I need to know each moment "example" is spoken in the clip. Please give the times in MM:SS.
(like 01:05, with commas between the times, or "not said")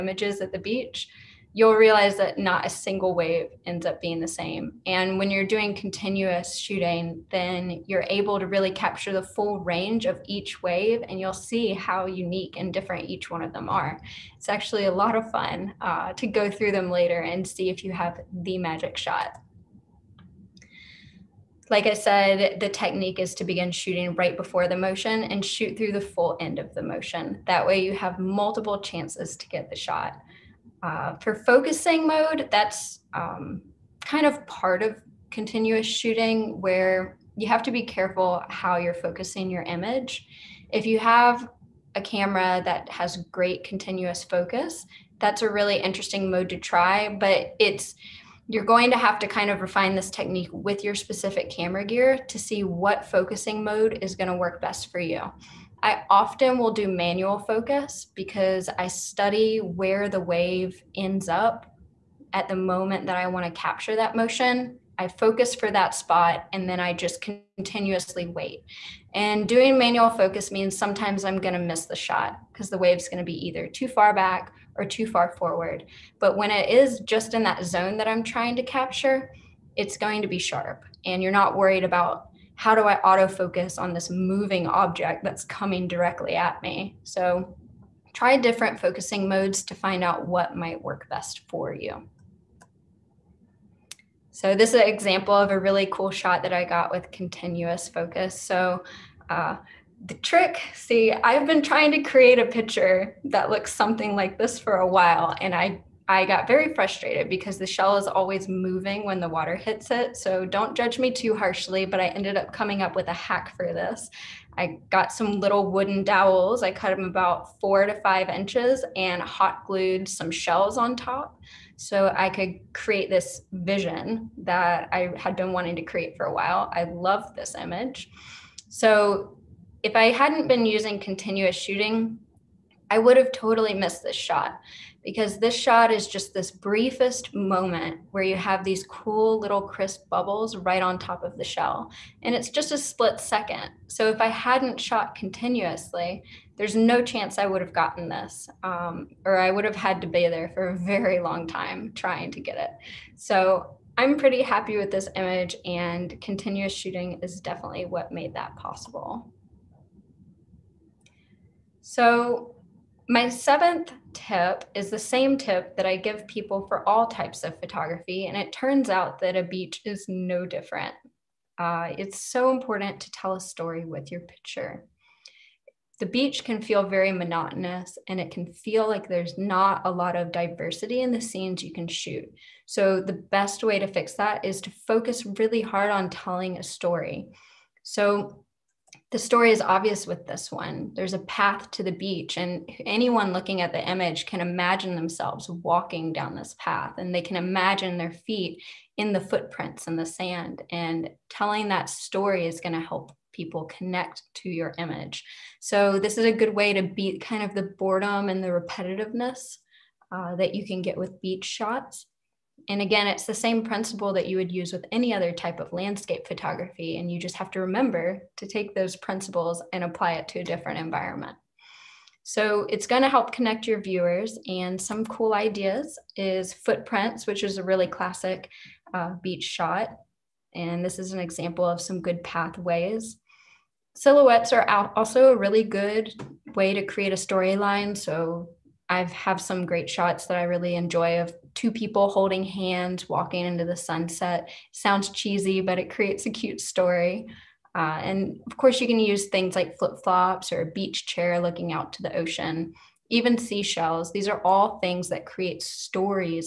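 01:34, 03:51.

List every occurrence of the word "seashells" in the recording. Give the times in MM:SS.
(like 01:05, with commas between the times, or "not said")
04:13.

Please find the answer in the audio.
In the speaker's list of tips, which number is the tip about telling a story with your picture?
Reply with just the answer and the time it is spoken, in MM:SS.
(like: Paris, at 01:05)
Seventh, at 02:43.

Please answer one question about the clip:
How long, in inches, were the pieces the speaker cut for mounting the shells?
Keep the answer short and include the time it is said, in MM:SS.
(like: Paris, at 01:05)
4 to 5 inches, at 01:57.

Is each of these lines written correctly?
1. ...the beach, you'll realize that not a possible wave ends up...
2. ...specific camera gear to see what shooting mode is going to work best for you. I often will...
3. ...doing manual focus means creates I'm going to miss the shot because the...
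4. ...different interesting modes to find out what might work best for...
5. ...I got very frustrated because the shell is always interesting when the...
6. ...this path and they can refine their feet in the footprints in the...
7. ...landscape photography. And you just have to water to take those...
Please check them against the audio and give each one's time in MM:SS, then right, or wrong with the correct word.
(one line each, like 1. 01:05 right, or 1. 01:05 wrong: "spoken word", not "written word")
1. 00:00 wrong: "single", not "possible"
2. 00:50 wrong: "focusing", not "shooting"
3. 01:09 wrong: "sometimes", not "creates"
4. 01:28 wrong: "focusing", not "interesting"
5. 01:46 wrong: "moving", not "interesting"
6. 03:16 wrong: "imagine", not "refine"
7. 03:35 wrong: "remember", not "water".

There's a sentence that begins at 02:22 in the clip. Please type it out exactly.
And it's just a split second.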